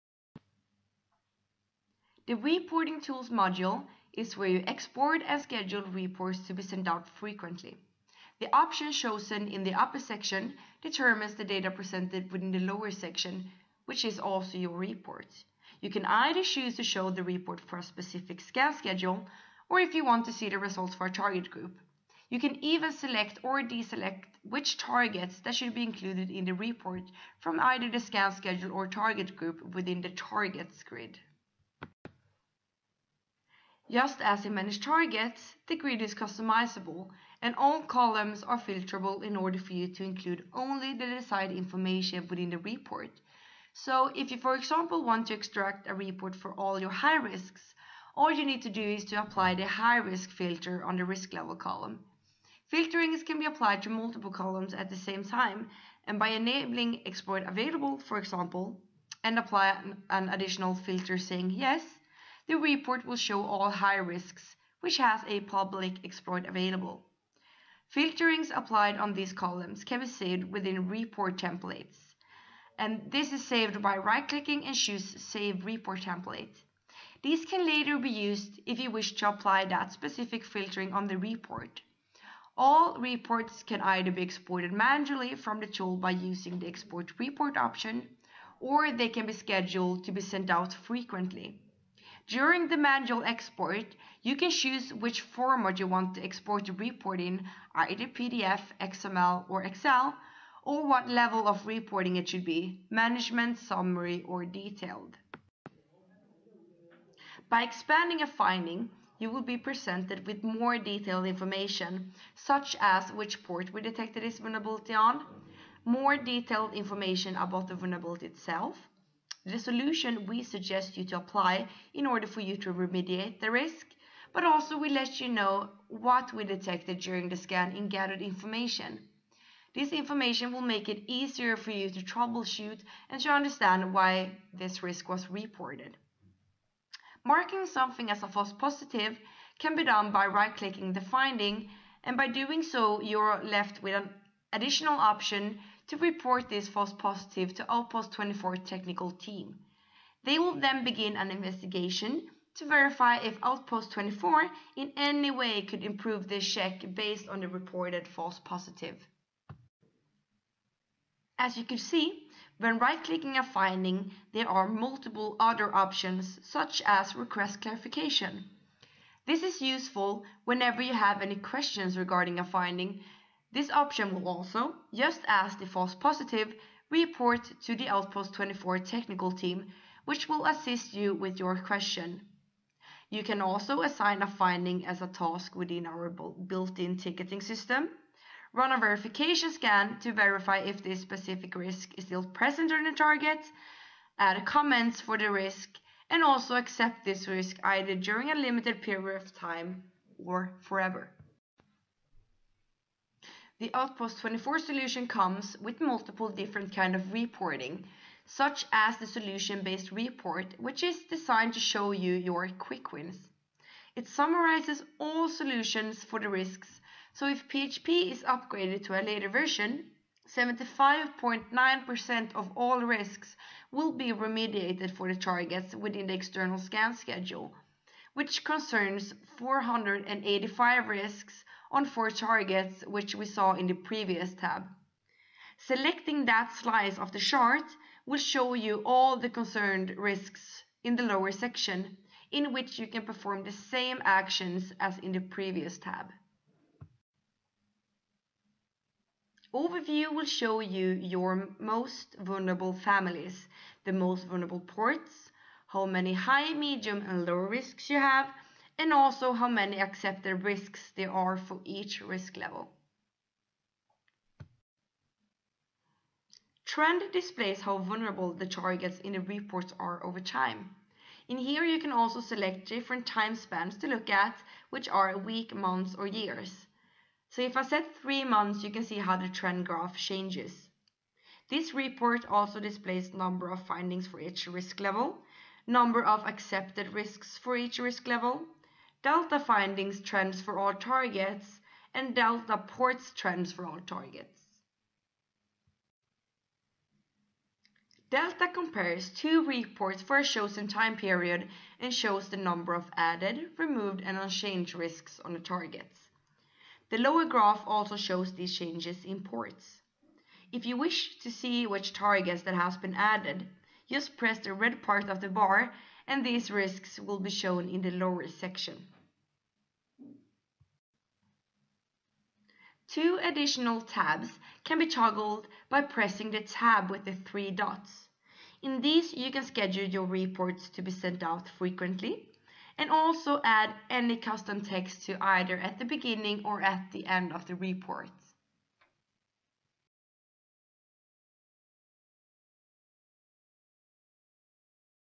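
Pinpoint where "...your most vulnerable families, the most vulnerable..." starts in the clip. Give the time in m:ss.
4:10.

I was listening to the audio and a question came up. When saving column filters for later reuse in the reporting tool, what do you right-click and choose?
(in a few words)
Save Report Template.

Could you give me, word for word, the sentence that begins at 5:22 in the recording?
Two additional tabs can be toggled by pressing the tab with the three dots.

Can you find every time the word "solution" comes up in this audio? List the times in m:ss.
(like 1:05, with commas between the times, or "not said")
1:59, 3:24, 3:29, 3:35.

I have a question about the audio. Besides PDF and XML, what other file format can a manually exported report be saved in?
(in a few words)
Excel.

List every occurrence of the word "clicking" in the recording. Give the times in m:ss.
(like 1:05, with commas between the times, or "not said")
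1:13, 2:20, 2:42.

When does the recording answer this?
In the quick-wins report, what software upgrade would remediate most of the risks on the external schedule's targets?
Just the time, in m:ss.
3:37.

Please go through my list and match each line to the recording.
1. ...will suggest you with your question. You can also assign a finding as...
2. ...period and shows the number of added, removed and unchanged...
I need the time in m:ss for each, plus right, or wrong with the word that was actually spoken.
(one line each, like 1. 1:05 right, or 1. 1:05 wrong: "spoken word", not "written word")
1. 3:00 wrong: "assist", not "suggest"
2. 5:00 right.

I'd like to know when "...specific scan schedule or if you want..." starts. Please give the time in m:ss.
0:17.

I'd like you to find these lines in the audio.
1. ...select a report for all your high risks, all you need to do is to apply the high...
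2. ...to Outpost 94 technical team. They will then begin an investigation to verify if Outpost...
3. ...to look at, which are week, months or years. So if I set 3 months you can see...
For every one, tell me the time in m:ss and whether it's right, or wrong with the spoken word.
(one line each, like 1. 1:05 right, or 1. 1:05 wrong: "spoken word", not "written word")
1. 0:45 wrong: "extract", not "select"
2. 2:27 wrong: "24", not "94"
3. 4:33 right.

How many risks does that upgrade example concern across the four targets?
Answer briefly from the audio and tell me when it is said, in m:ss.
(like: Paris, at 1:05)
485, at 3:49.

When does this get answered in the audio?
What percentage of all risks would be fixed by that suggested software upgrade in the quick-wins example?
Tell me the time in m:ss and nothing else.
3:40.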